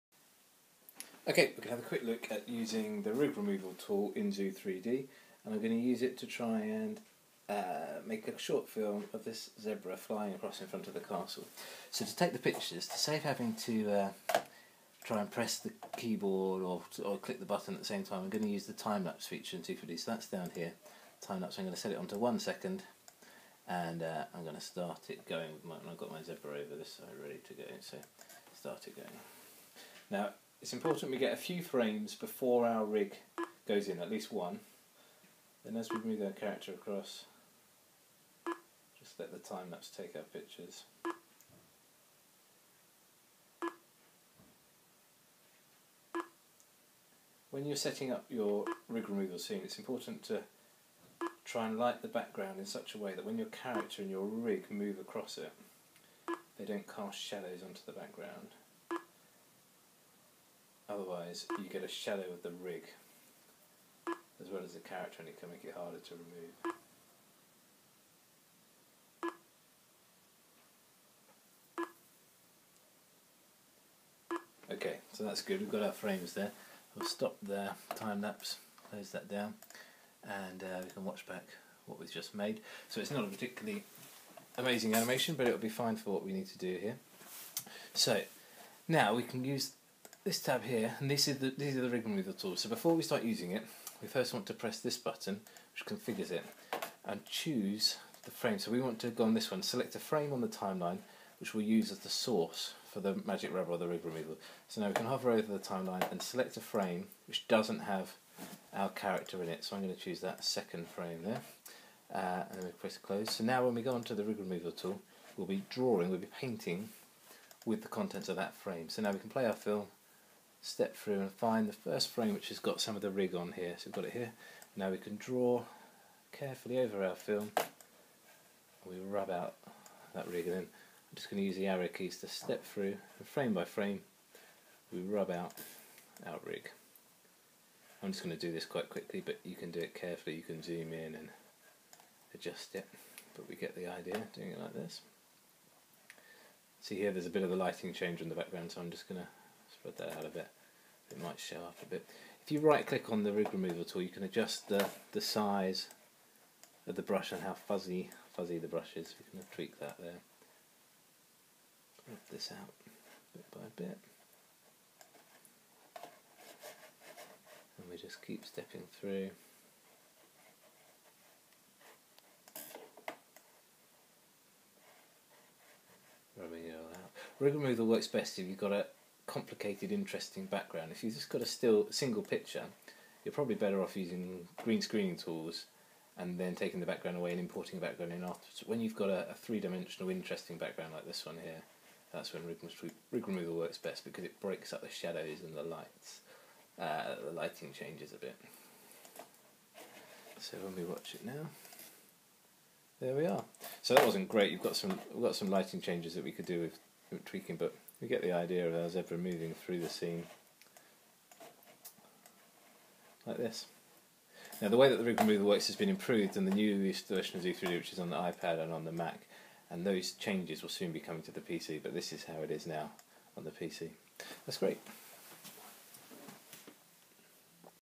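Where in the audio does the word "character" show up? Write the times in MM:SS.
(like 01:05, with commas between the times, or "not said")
00:36, 00:53, 01:04, 01:48.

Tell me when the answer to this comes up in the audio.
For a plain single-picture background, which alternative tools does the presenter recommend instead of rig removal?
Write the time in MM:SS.
03:04.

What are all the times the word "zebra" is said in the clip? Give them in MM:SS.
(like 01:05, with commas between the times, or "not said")
00:09, 00:26, 03:28.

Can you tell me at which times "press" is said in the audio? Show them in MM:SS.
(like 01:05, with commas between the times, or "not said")
00:15, 01:34, 01:52.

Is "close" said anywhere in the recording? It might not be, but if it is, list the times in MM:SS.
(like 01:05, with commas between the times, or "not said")
01:18, 01:52.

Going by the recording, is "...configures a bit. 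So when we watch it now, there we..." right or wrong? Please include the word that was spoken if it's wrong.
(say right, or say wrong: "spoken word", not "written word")
wrong: "changes", not "configures".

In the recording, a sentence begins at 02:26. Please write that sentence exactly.
See here there's a bit of the lighting change in the background so I'm just going to spread that out a bit.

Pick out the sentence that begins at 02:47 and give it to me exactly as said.
And we just keep stepping through.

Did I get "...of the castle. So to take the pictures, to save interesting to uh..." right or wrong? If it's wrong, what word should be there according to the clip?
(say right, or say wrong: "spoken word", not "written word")
wrong: "having", not "interesting".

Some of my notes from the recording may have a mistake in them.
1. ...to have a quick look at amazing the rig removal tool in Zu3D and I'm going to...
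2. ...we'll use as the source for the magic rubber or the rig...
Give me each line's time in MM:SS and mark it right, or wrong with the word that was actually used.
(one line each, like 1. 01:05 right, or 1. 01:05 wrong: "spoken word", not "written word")
1. 00:01 wrong: "using", not "amazing"
2. 01:41 right.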